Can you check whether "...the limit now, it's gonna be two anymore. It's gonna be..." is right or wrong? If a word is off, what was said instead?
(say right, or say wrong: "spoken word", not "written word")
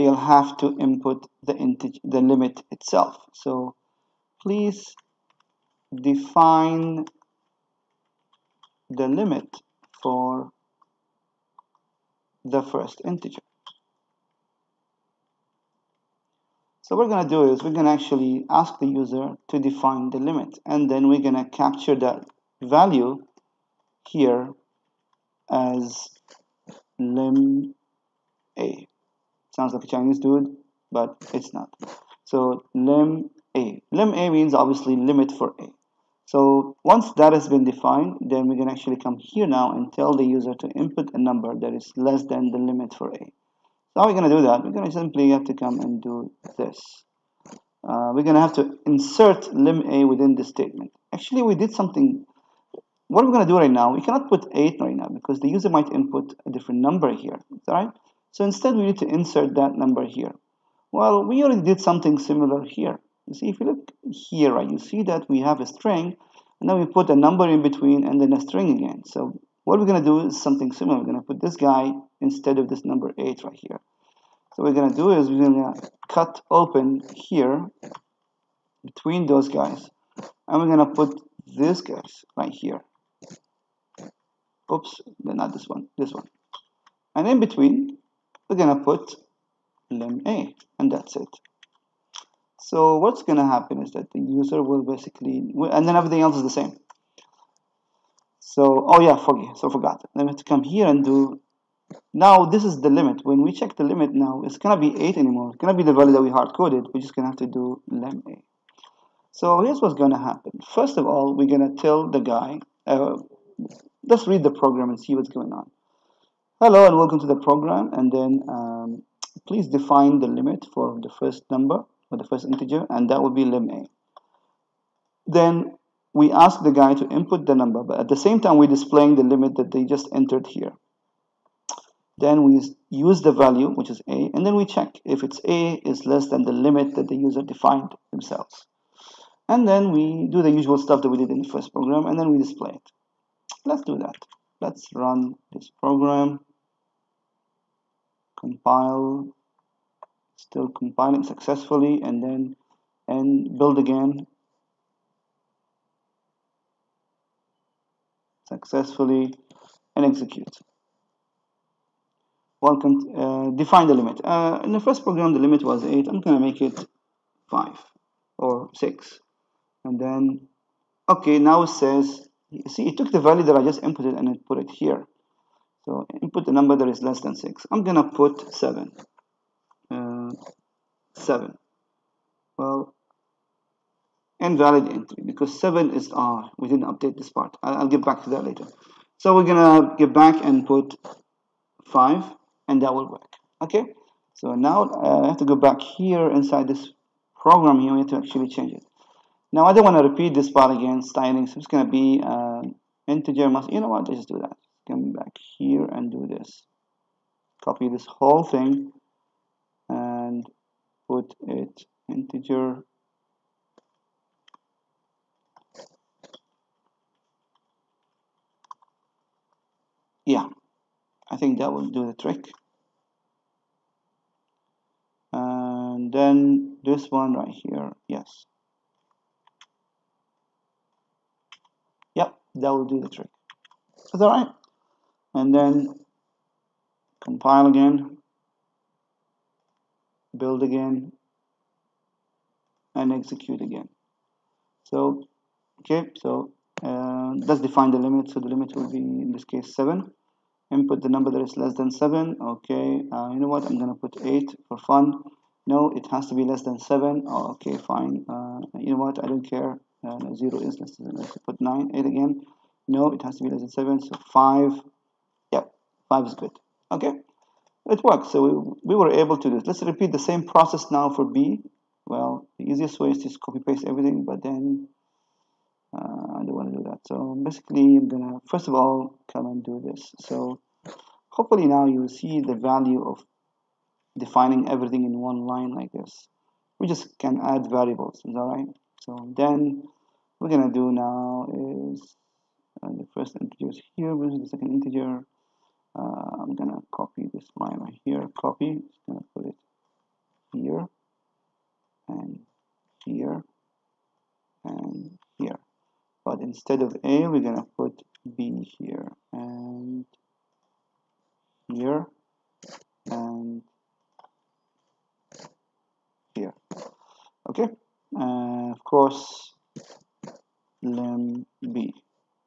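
wrong: "eight", not "two".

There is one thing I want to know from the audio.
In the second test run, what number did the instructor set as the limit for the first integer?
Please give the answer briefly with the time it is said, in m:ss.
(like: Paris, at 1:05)
7, at 4:08.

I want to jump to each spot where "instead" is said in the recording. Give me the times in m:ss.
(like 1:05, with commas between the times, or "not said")
0:58, 1:12, 5:06.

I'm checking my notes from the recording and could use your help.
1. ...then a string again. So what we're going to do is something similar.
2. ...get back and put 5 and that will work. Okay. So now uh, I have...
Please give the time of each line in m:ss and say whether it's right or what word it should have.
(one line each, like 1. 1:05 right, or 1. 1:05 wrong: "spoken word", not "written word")
1. 1:08 right
2. 3:09 right.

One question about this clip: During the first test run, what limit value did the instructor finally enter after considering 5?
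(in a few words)
6.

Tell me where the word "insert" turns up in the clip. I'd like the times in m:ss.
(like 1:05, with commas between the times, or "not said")
0:48, 0:59.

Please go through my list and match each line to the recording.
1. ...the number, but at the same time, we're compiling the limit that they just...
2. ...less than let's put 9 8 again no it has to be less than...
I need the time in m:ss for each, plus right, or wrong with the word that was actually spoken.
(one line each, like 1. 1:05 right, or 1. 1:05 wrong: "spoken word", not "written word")
1. 2:07 wrong: "displaying", not "compiling"
2. 4:20 right.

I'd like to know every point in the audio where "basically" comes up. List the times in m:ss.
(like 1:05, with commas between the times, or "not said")
1:34, 4:37.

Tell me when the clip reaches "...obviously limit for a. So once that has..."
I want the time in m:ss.
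0:34.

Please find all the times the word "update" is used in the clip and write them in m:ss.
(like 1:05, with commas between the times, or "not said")
3:06.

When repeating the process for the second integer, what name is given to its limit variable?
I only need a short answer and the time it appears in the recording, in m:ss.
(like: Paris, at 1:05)
lim B, at 5:20.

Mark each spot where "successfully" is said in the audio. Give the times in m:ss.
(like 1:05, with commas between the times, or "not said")
2:31, 2:38.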